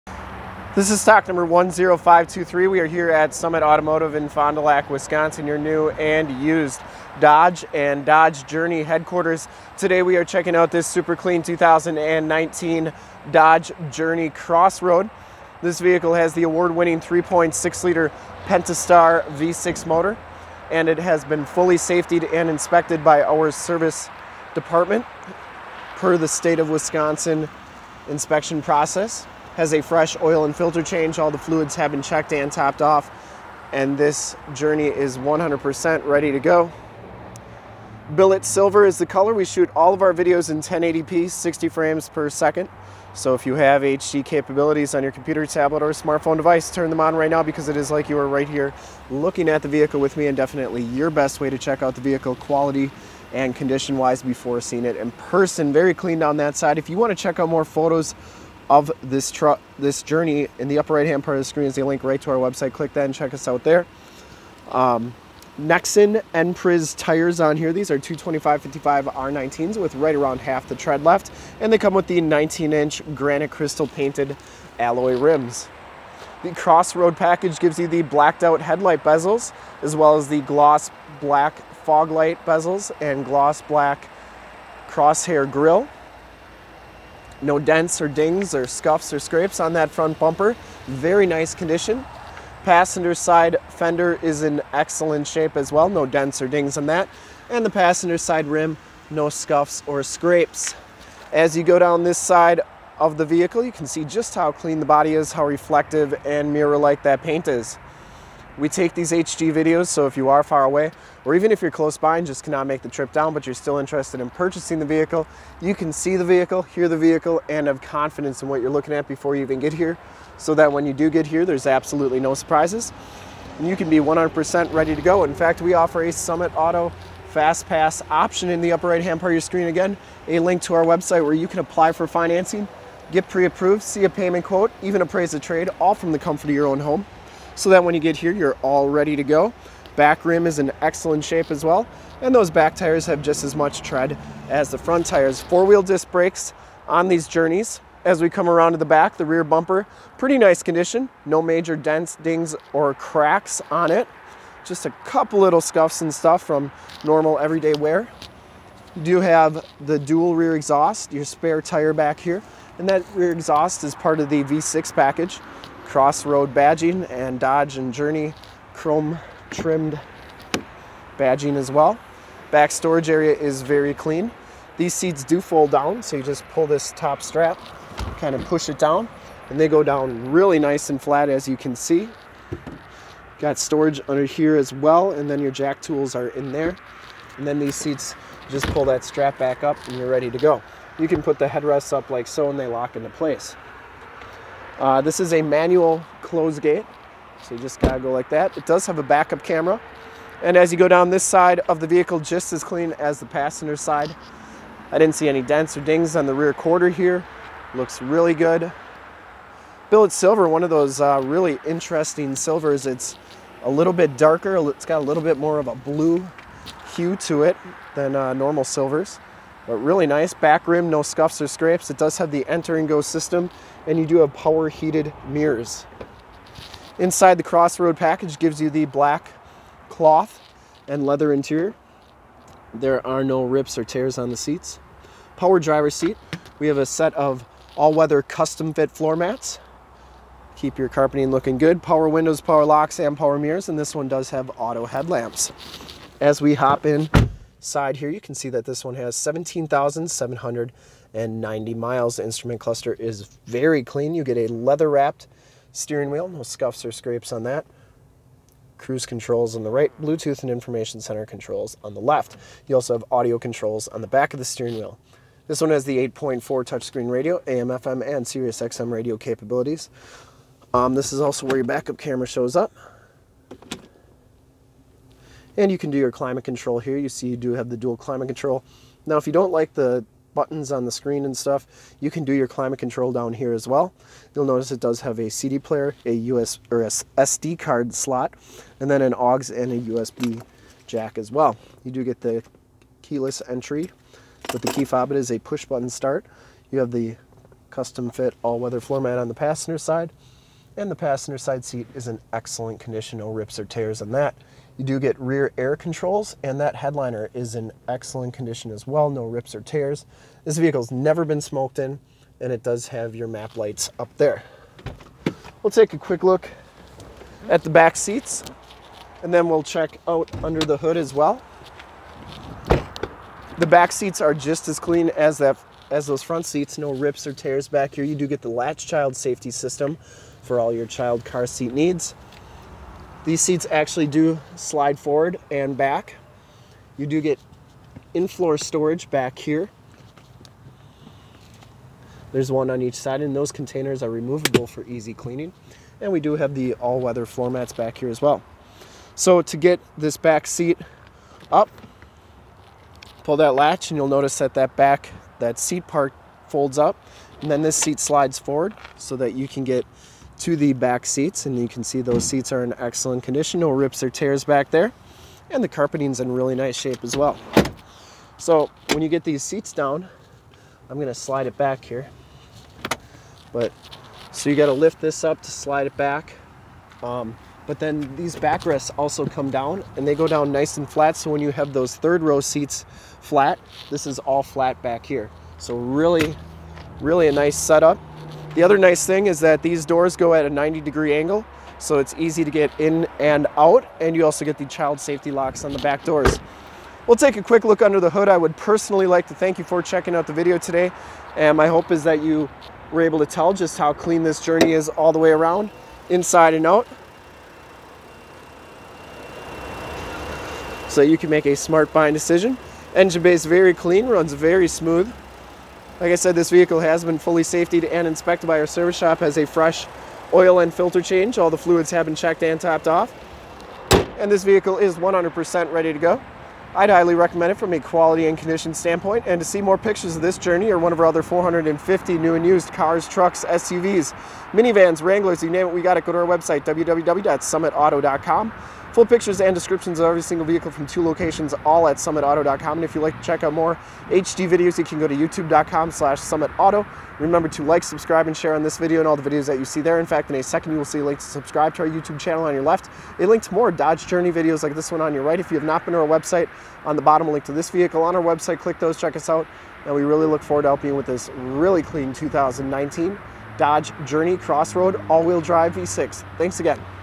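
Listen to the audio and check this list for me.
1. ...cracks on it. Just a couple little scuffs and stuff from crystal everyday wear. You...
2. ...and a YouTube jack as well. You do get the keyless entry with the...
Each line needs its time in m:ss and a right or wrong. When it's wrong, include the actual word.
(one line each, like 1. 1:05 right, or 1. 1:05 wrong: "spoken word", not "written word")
1. 2:32 wrong: "normal", not "crystal"
2. 4:49 wrong: "USB", not "YouTube".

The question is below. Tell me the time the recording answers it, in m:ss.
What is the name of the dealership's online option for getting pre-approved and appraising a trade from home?
2:06.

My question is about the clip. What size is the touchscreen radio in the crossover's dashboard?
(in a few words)
8.4.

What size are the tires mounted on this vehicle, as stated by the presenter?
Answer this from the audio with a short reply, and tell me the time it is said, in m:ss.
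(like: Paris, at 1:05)
225 55 R19, at 1:07.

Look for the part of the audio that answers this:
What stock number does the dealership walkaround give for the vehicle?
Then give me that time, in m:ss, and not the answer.
0:01.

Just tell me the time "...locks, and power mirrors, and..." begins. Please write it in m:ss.
4:02.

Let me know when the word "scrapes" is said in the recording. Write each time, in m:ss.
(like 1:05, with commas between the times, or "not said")
1:29, 1:40, 3:41, 4:16.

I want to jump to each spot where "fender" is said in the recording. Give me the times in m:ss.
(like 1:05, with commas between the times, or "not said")
1:33.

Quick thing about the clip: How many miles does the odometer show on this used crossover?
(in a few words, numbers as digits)
17,790.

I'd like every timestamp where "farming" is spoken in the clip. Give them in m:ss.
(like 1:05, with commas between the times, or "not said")
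not said.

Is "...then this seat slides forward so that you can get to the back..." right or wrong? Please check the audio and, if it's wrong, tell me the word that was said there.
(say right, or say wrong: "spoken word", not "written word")
right.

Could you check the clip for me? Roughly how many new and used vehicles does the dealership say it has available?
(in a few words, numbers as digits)
450.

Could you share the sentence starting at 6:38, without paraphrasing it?
I would personally like to thank you for checking out the video today.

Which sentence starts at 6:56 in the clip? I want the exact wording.
Like I said, this vehicle has been fully safety and inspected by our service shop, has a fresh oil and filter change.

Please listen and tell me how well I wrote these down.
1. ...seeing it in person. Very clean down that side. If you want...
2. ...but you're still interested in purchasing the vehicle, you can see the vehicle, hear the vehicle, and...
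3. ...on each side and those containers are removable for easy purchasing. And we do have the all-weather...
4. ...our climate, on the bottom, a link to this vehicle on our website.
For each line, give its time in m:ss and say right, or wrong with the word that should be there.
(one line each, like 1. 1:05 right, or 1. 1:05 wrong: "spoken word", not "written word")
1. 0:54 right
2. 1:53 right
3. 5:42 wrong: "cleaning", not "purchasing"
4. 7:36 wrong: "website", not "climate".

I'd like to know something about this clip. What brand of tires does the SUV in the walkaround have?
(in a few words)
Nexen.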